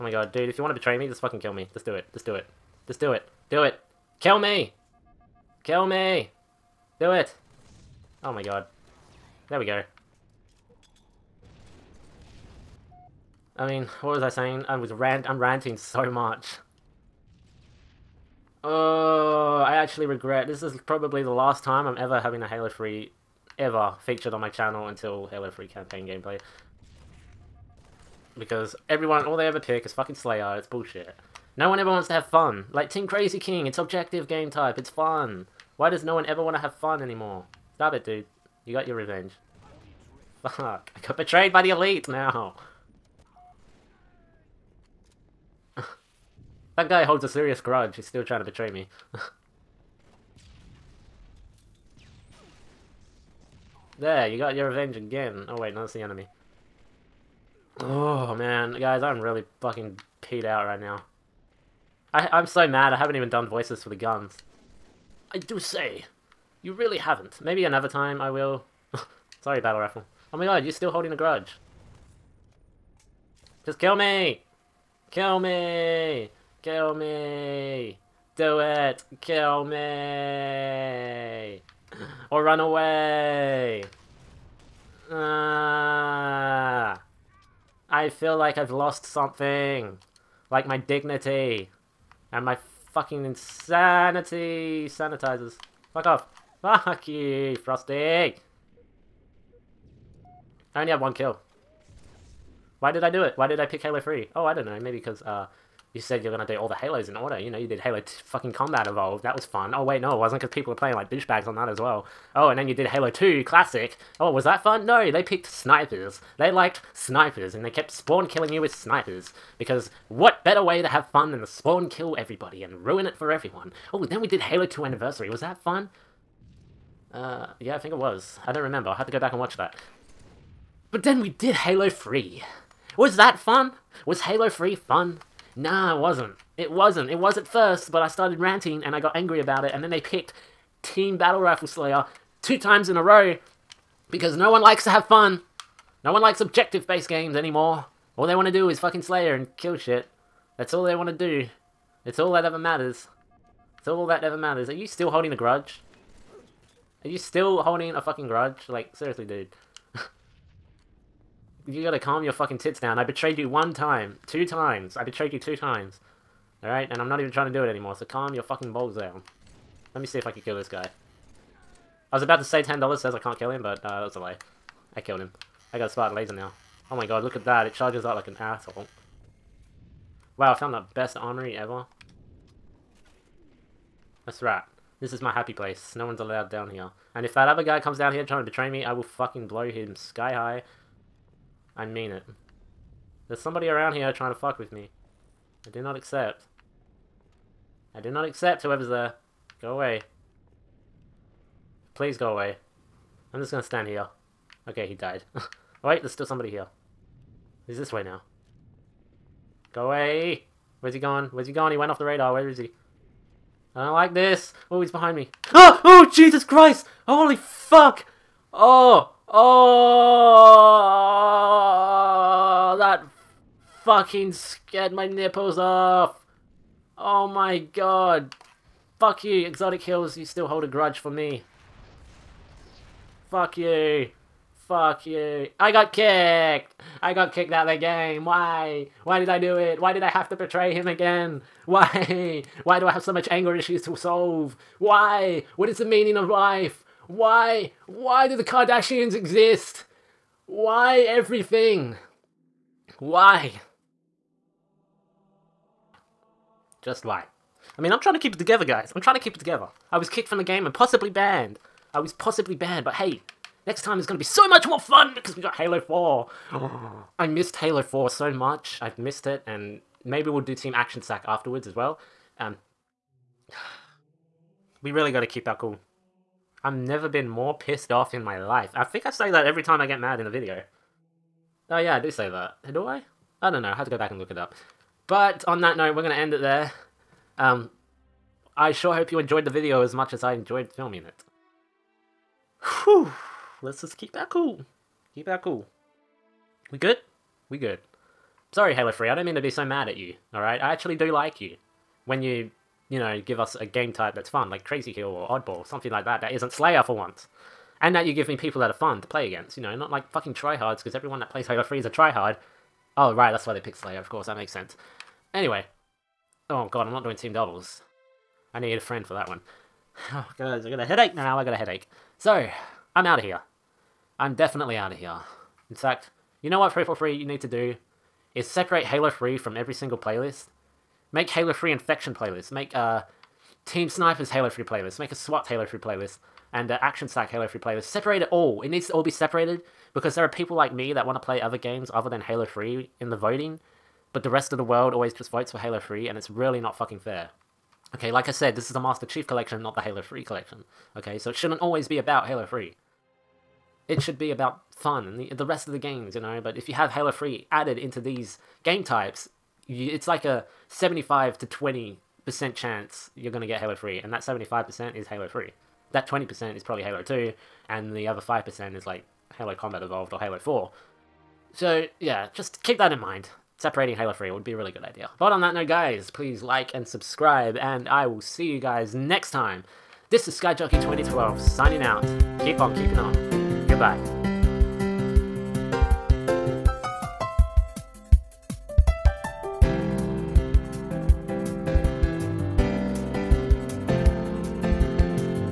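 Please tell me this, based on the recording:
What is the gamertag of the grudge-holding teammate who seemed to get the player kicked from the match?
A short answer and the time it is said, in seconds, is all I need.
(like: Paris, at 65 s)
Exotic Hills, at 229 s.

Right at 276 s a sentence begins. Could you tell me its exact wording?
I've never been more pissed off in my life.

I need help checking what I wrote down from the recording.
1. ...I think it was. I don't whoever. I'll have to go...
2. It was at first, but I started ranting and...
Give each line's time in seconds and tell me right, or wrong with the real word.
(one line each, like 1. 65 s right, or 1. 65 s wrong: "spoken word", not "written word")
1. 127 s wrong: "remember", not "whoever"
2. 137 s right.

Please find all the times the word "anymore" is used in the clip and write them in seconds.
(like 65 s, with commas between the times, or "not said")
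37 s, 147 s, 167 s.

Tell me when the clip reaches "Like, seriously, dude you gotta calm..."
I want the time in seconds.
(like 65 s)
158 s.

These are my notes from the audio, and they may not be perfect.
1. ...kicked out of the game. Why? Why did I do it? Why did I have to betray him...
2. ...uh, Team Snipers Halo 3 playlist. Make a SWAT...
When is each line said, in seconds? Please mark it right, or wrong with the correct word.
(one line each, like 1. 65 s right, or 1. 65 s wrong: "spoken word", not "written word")
1. 237 s right
2. 332 s right.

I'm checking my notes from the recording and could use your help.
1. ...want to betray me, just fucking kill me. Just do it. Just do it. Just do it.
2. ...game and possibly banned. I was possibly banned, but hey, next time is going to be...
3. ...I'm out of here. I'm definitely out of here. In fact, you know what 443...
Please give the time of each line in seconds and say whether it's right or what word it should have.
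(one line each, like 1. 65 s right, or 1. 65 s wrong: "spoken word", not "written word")
1. 0 s right
2. 260 s right
3. 322 s wrong: "343", not "443".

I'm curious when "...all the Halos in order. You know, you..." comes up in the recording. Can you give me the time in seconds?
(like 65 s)
106 s.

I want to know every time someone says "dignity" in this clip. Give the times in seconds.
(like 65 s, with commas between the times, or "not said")
90 s.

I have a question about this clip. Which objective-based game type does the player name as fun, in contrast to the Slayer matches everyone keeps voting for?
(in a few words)
Team Crazy King.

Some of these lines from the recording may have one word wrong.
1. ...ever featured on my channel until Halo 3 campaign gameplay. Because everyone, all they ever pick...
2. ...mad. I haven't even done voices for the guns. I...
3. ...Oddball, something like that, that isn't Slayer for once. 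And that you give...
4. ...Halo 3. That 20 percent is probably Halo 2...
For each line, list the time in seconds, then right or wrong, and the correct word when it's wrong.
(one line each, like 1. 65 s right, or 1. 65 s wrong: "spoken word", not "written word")
1. 23 s right
2. 62 s right
3. 305 s right
4. 365 s right.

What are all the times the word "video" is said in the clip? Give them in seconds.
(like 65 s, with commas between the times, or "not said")
280 s, 289 s.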